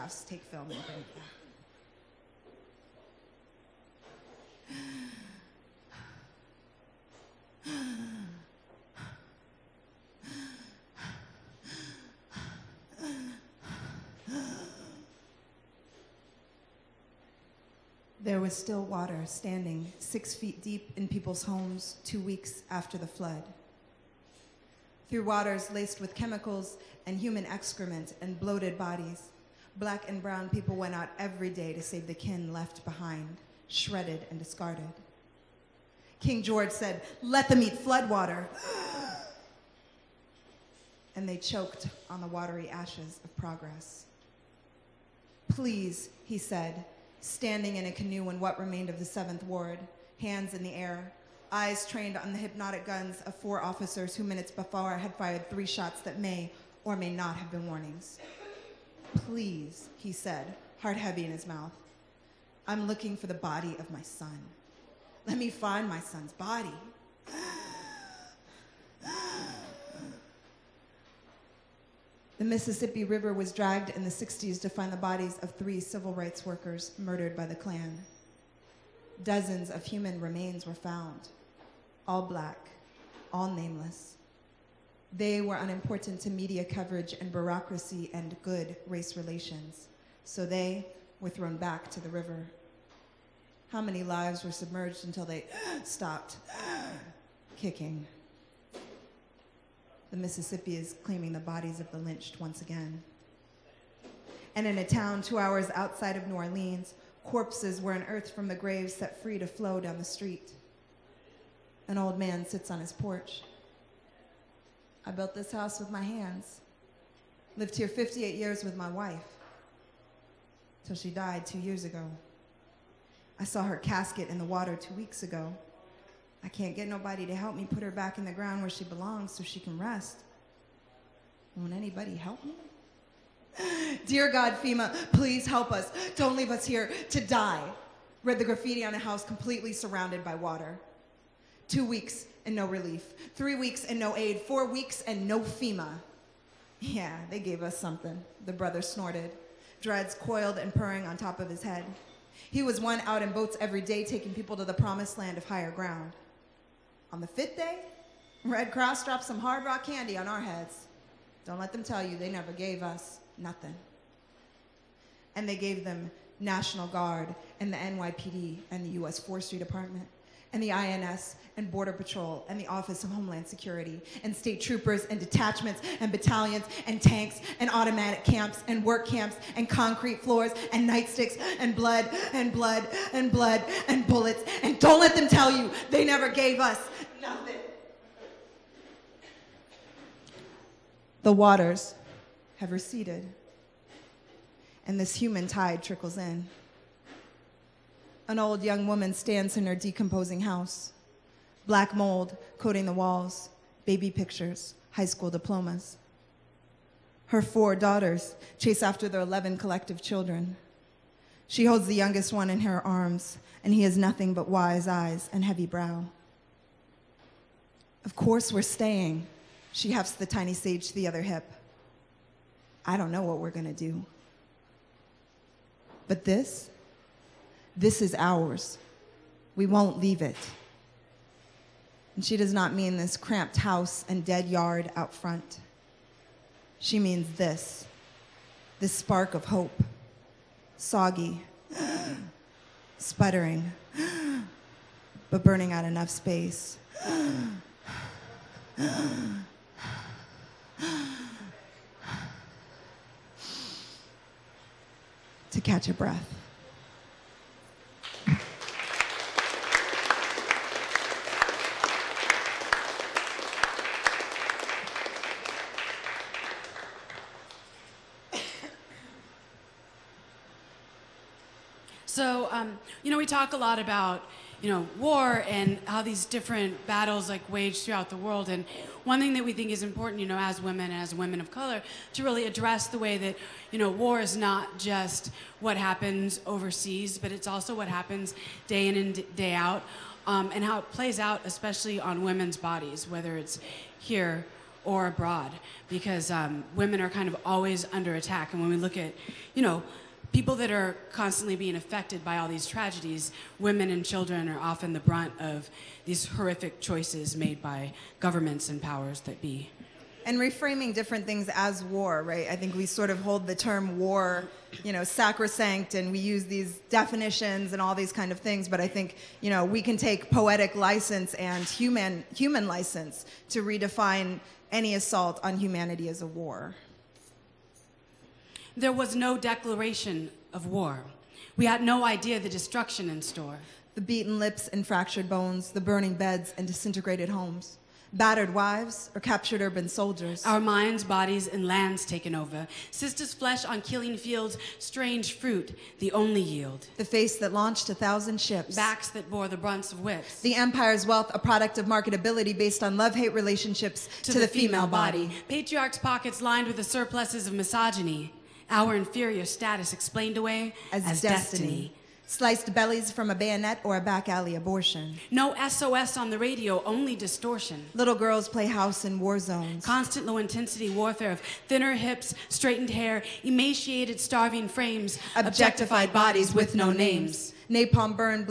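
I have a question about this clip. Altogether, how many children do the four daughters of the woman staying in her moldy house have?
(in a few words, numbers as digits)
11.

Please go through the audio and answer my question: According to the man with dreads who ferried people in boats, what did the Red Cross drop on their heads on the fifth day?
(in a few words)
hard rock candy.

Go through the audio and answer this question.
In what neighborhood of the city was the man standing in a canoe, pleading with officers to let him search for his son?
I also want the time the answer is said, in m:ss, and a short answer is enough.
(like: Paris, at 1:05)
Seventh Ward, at 0:49.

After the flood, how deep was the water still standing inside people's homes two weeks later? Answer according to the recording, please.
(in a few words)
6 feet.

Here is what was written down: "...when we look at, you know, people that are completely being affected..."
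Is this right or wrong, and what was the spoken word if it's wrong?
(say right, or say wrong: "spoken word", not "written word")
wrong: "constantly", not "completely".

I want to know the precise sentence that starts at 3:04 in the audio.
And don't let them tell you they never gave us nothing.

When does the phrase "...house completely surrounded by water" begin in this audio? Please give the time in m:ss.
2:18.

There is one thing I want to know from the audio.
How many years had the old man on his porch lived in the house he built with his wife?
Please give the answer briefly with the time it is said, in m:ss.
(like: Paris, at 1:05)
58, at 1:57.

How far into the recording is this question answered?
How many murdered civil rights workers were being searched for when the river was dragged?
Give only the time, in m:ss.
1:15.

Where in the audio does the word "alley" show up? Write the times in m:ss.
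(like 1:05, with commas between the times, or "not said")
6:04.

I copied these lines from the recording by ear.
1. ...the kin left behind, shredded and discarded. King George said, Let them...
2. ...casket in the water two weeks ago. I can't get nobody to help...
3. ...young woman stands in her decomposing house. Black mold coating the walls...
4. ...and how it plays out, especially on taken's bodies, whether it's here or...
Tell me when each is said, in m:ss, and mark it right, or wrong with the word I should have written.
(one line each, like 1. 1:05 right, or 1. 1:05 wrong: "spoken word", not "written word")
1. 0:32 right
2. 2:03 right
3. 3:18 right
4. 4:50 wrong: "women", not "taken".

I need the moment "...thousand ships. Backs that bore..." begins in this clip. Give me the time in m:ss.
5:47.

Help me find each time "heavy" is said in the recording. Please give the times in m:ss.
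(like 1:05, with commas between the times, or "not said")
1:00, 3:35.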